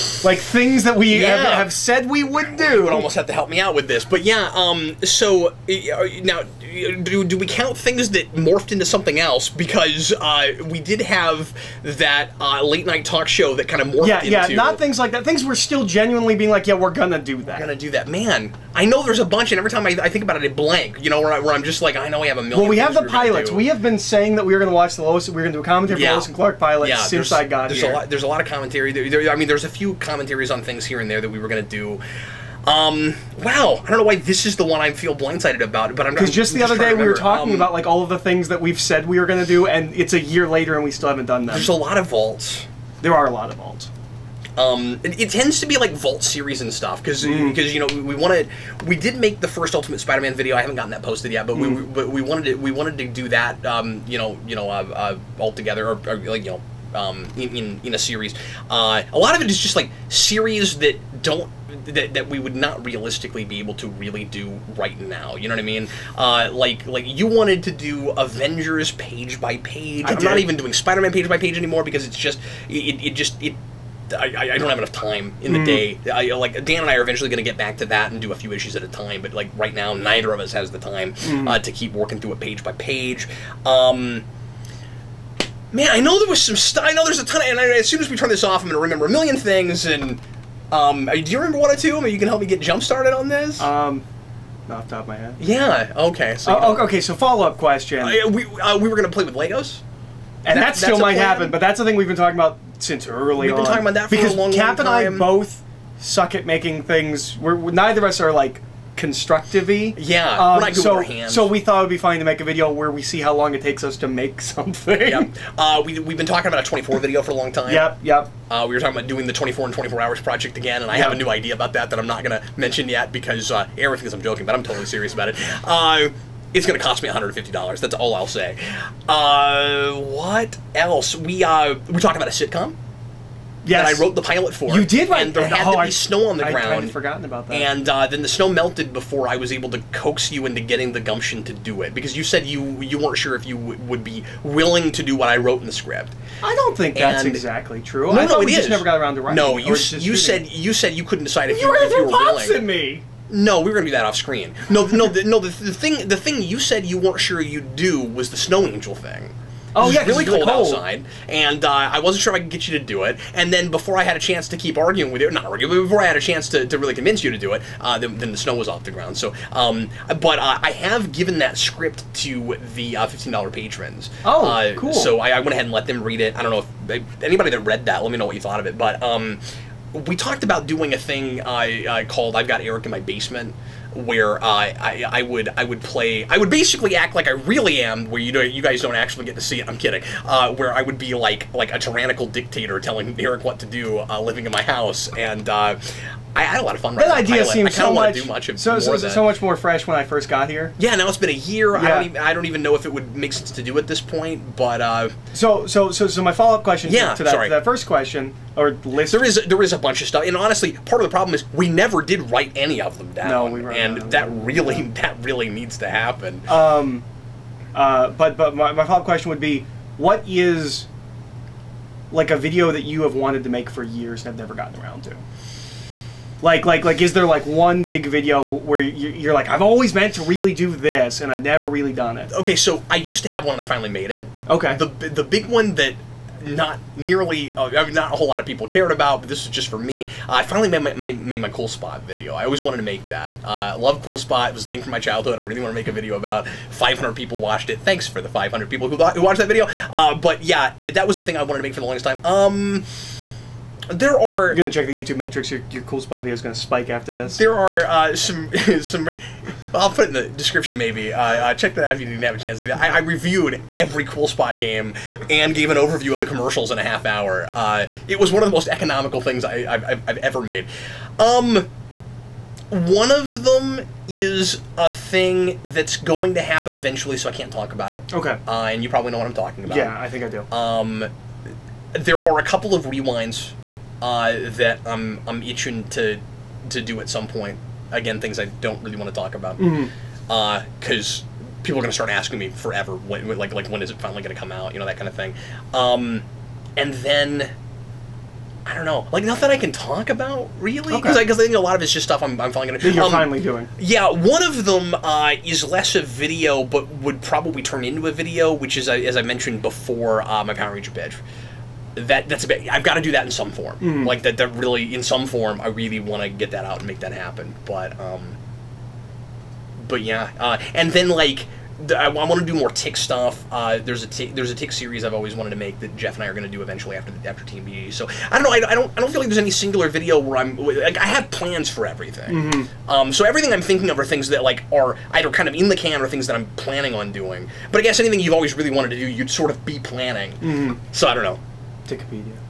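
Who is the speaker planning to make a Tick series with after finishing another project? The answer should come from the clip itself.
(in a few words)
Jeff.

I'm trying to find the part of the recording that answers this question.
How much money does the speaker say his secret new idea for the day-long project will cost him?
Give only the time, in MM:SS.
02:07.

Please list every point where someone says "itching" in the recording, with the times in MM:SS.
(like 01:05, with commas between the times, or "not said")
04:45.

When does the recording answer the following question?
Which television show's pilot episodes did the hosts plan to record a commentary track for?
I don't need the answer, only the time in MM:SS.
00:26.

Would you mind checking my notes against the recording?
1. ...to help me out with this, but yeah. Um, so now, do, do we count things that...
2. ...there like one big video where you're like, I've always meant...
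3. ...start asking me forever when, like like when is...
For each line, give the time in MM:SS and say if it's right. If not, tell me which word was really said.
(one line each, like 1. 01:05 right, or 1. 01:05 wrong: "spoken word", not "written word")
1. 00:03 right
2. 03:47 right
3. 04:51 right.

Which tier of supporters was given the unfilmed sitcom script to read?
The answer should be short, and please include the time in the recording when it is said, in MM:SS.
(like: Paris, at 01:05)
fifteen dollar patrons, at 02:53.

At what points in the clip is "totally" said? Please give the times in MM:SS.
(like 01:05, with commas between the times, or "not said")
02:04.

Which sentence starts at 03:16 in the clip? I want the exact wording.
That idea seems so much, much so, so, so, much more fresh when I first got here.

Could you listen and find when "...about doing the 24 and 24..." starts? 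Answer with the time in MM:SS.
01:58.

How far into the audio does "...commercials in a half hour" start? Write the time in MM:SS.
04:26.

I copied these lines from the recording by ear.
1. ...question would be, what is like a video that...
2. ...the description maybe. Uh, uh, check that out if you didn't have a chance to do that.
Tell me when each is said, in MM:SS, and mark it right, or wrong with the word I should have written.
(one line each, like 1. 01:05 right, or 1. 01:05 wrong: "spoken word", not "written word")
1. 03:39 right
2. 04:20 right.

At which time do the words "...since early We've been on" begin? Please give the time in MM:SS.
01:42.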